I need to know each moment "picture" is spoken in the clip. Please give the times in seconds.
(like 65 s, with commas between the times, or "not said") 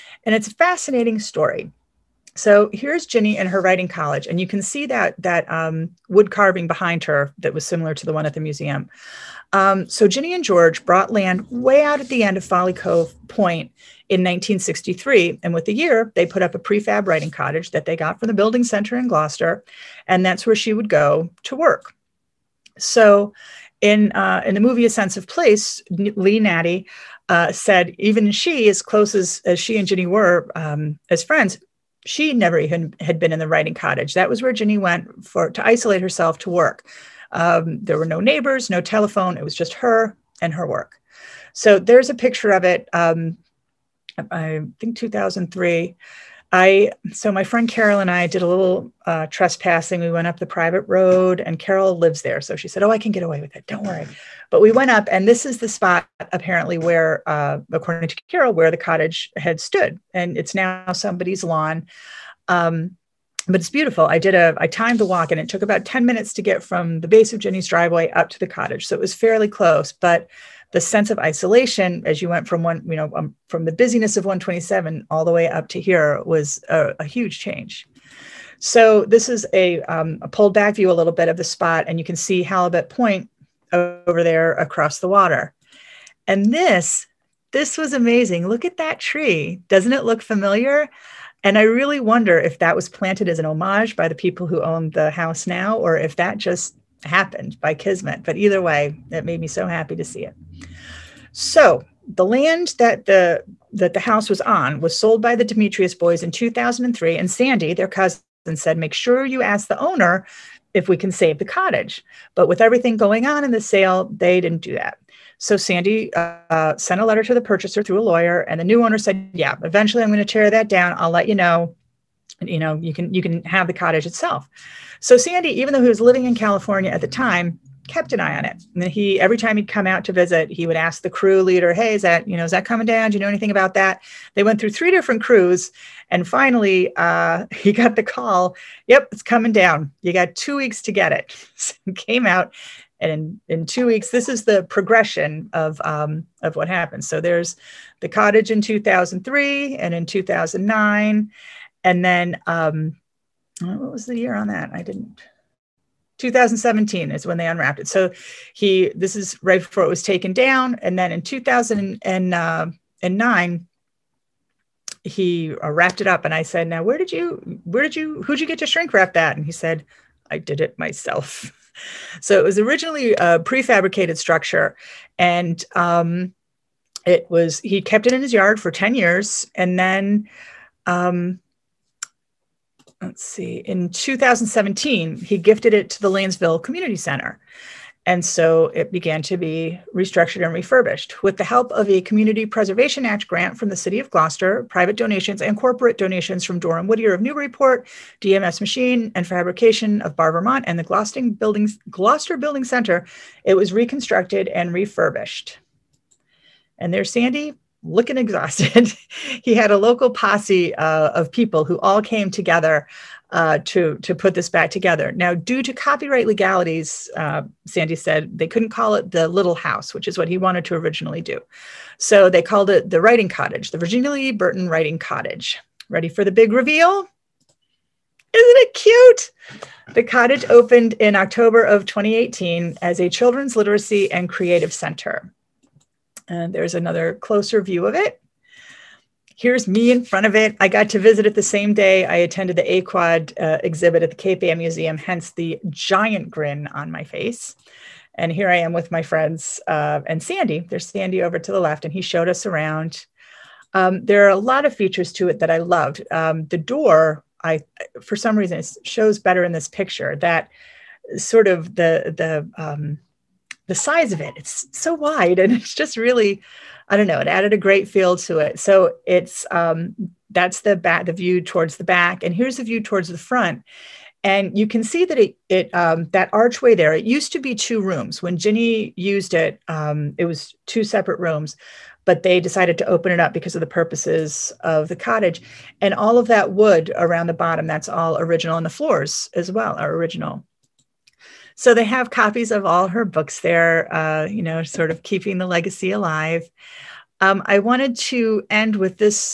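42 s, 259 s.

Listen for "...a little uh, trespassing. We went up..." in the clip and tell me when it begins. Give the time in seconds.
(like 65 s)
48 s.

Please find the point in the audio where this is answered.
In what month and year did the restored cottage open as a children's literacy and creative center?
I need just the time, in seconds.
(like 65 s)
231 s.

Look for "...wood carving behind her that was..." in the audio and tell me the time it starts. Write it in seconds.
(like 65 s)
6 s.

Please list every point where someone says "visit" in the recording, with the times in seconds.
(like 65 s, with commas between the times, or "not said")
130 s, 240 s.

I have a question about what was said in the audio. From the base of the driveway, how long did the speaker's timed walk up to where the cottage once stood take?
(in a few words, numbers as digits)
10 minutes.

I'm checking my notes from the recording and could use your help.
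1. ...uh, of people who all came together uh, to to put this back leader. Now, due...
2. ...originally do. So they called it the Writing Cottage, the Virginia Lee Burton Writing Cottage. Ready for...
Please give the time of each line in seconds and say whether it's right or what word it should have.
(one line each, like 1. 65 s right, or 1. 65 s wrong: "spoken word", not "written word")
1. 210 s wrong: "together", not "leader"
2. 220 s right.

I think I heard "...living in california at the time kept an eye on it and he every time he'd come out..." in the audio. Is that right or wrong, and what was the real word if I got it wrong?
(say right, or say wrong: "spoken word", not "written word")
right.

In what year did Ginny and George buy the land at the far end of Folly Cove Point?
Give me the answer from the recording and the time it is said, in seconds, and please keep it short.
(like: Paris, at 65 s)
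1963, at 14 s.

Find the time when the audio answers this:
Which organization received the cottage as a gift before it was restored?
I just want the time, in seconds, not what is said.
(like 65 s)
186 s.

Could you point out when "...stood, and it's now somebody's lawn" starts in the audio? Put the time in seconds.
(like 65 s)
59 s.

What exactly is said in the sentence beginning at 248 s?
And here I am with my friends uh, and Sandy.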